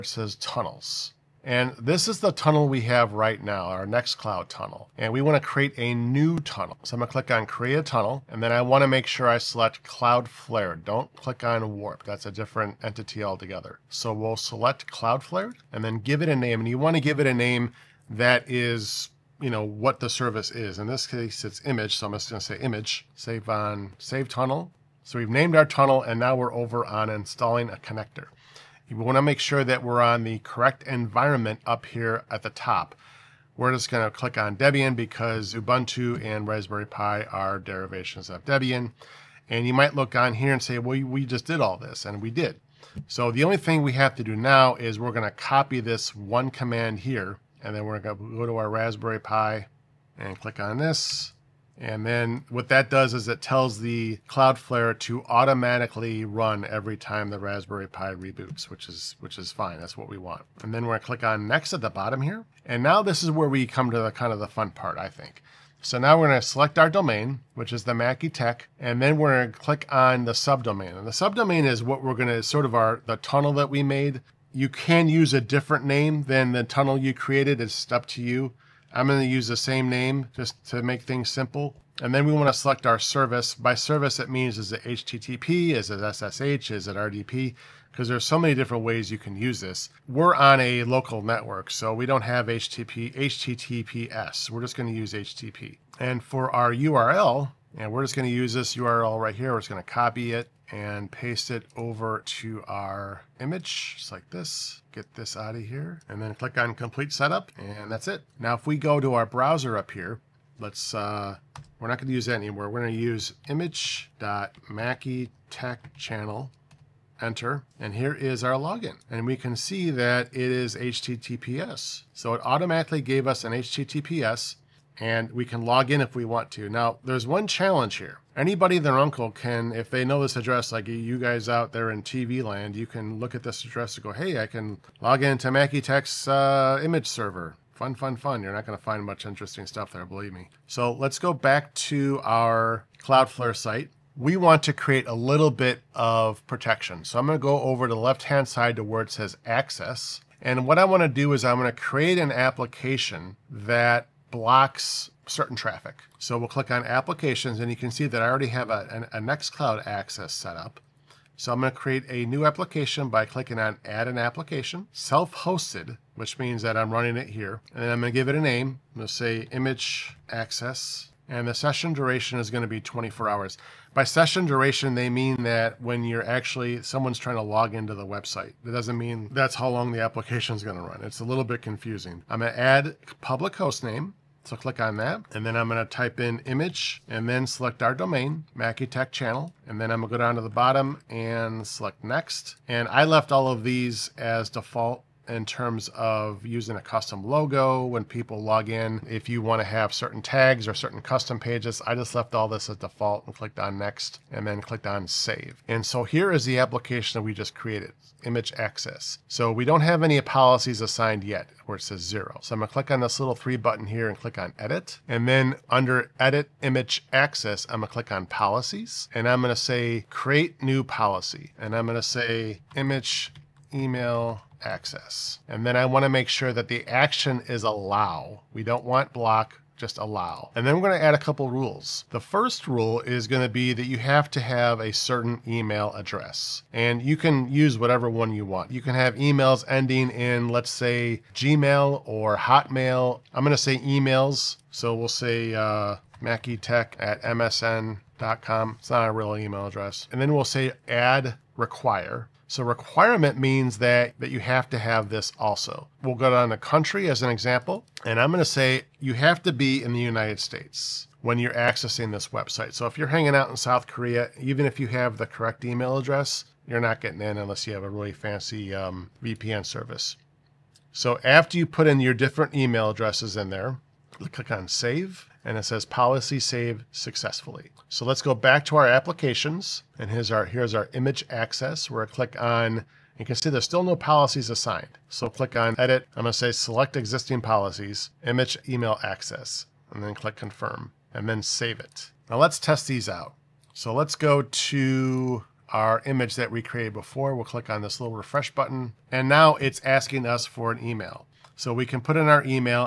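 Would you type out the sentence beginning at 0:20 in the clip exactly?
In this case, it's Immich, so I'm just going to say Immich.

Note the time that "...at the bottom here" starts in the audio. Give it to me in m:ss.
1:01.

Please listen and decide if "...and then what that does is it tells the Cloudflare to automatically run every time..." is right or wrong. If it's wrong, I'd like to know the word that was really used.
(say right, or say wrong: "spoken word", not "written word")
right.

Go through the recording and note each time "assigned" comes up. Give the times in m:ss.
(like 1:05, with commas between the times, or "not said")
3:30, 4:44.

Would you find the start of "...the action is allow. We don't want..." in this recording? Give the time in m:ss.
3:46.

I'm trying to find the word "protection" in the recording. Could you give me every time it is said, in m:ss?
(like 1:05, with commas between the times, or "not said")
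2:26.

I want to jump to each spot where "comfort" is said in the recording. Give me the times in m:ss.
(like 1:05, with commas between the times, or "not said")
not said.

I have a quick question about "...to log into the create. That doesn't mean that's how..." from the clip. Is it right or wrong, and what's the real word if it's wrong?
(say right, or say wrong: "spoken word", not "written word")
wrong: "website", not "create".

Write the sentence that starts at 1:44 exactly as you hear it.
Get this out of here, and then click on Complete Setup, and that's it.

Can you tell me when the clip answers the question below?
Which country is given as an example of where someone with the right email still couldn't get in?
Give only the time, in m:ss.
4:23.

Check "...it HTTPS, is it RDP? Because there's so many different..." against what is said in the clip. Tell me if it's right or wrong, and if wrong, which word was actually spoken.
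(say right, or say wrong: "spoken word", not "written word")
wrong: "SSH", not "HTTPS".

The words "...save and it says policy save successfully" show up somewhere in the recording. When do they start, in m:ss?
4:34.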